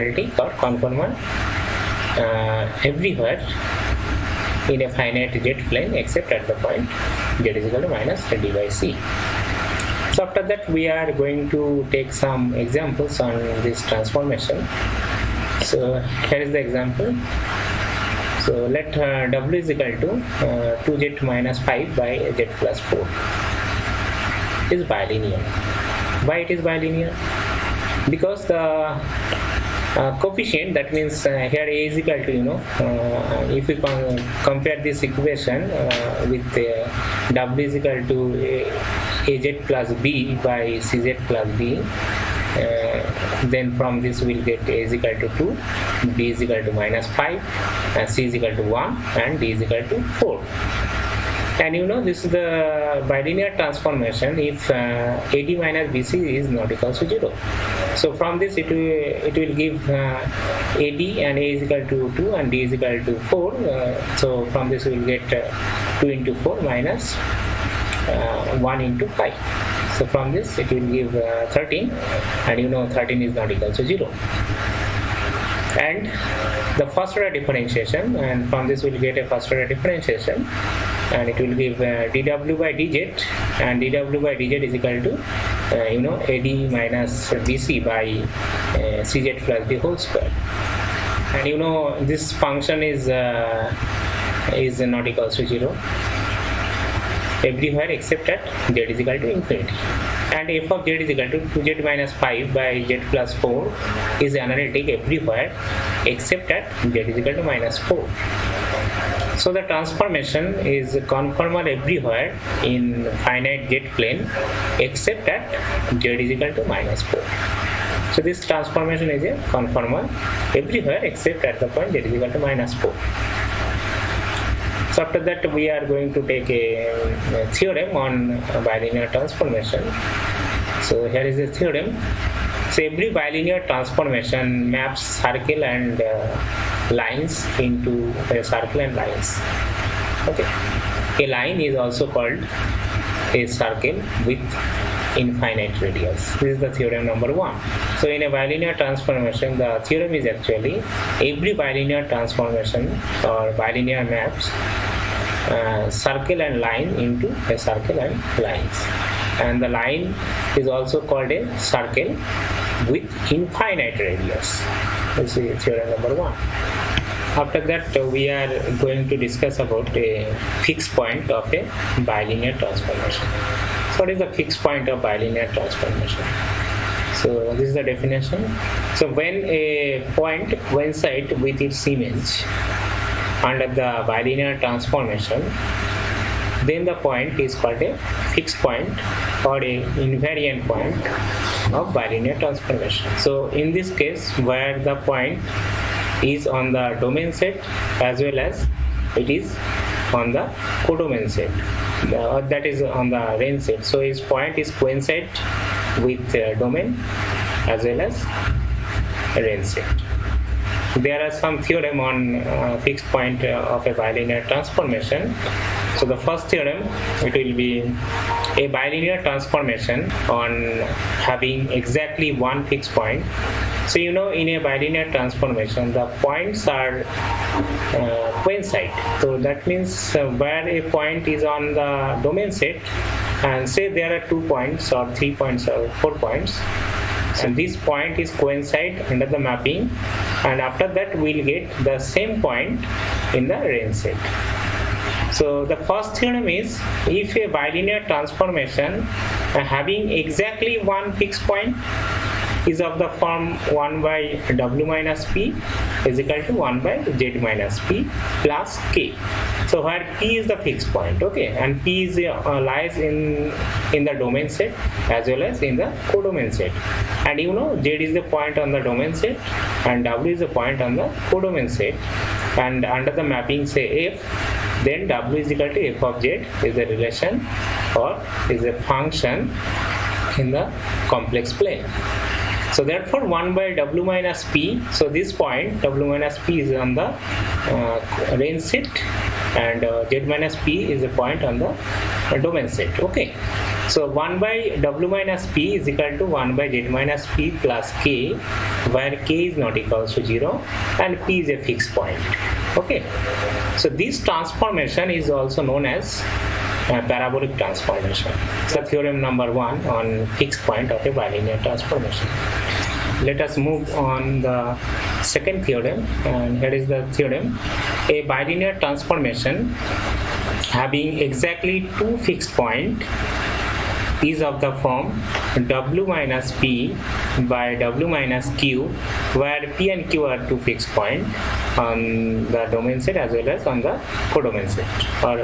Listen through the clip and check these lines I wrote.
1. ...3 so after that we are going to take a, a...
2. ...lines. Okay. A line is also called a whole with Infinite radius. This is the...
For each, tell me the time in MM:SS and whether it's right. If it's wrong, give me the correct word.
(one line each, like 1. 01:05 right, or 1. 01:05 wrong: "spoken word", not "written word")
1. 02:02 wrong: "4", not "3"
2. 02:18 wrong: "circle", not "whole".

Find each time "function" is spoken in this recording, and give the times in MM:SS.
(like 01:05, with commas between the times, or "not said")
01:32, 04:38.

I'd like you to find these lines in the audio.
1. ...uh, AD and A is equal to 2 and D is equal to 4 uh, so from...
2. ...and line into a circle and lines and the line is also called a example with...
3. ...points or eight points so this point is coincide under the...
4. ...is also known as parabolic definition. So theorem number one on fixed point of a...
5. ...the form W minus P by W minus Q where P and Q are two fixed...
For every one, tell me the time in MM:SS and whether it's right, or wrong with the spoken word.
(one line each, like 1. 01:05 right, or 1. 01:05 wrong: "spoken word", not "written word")
1. 00:59 right
2. 02:36 wrong: "circle", not "example"
3. 03:55 wrong: "four", not "eight"
4. 05:05 wrong: "transformation", not "definition"
5. 05:24 right.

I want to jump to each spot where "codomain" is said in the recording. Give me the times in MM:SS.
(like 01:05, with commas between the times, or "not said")
03:20, 04:26, 04:31, 05:34.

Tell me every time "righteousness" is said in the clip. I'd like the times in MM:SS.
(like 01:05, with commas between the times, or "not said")
not said.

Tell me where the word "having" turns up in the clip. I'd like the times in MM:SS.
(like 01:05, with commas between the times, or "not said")
03:41, 04:09, 05:20.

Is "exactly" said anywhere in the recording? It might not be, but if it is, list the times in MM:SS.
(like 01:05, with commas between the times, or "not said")
03:41, 04:10, 05:21.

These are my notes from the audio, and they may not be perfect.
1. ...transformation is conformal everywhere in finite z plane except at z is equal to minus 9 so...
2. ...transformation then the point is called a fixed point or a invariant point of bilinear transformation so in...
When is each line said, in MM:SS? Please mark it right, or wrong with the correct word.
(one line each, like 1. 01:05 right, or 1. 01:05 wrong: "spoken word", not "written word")
1. 01:49 wrong: "4", not "9"
2. 03:04 right.